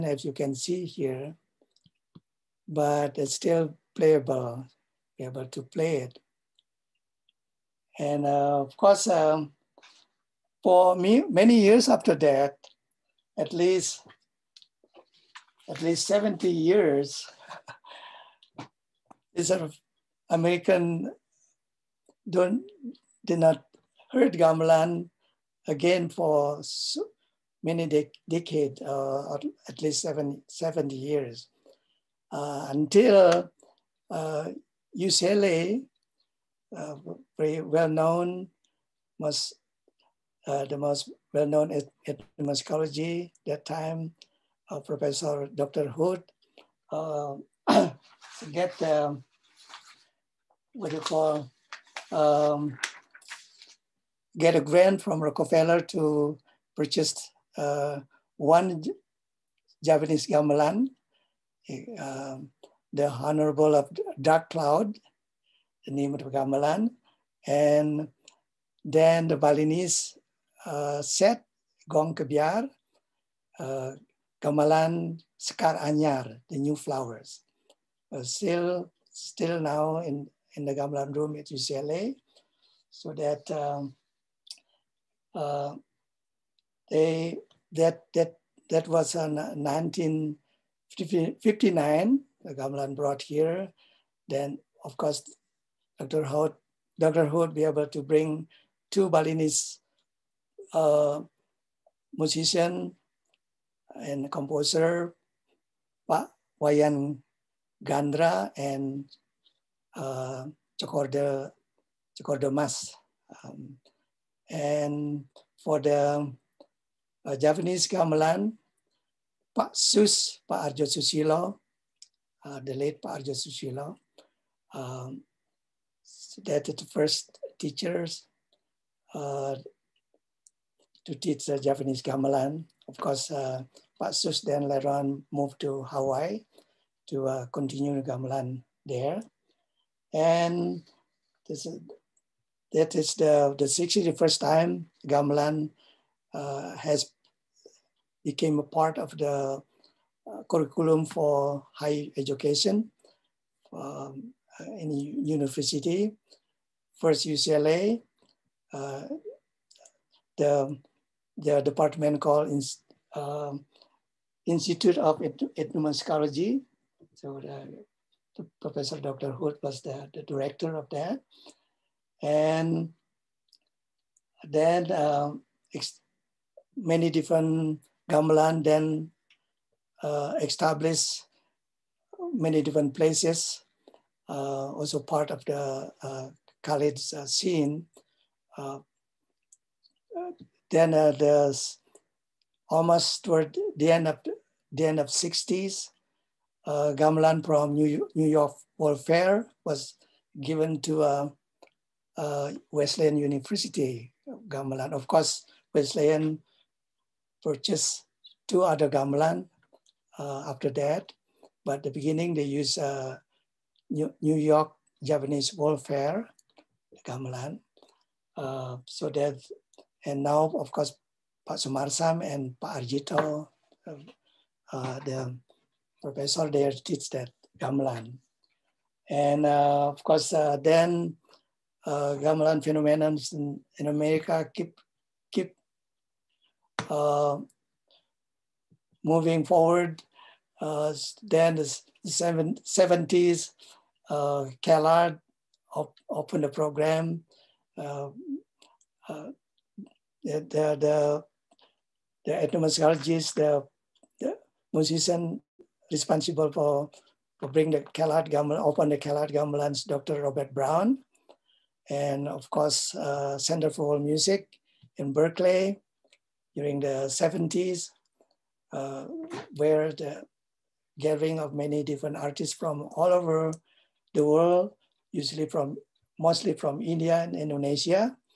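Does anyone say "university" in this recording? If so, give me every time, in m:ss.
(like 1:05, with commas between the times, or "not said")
2:35, 3:23.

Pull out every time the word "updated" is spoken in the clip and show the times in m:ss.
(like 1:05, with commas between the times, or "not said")
not said.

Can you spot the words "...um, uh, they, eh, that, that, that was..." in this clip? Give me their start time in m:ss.
1:23.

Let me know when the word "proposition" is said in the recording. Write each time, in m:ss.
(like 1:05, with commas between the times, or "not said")
not said.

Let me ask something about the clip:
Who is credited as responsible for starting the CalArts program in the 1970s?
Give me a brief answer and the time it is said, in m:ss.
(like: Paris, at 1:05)
Dr. Robert Brown, at 4:19.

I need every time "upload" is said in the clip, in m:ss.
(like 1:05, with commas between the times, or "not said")
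not said.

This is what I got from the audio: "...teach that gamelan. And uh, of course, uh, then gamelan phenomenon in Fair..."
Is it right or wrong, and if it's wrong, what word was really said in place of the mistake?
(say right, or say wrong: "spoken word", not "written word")
wrong: "America", not "Fair".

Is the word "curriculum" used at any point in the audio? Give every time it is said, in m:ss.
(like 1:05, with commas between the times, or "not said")
2:30.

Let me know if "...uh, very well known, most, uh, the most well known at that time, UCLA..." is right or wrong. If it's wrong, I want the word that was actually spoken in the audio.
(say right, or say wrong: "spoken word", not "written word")
wrong: "Professor", not "UCLA".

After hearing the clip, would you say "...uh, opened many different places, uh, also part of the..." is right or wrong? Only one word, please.
wrong.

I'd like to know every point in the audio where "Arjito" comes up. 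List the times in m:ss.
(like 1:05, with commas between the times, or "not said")
3:42.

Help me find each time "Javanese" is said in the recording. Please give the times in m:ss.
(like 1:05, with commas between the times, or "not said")
0:59, 1:57, 2:11, 3:35.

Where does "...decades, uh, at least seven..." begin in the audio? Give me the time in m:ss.
0:28.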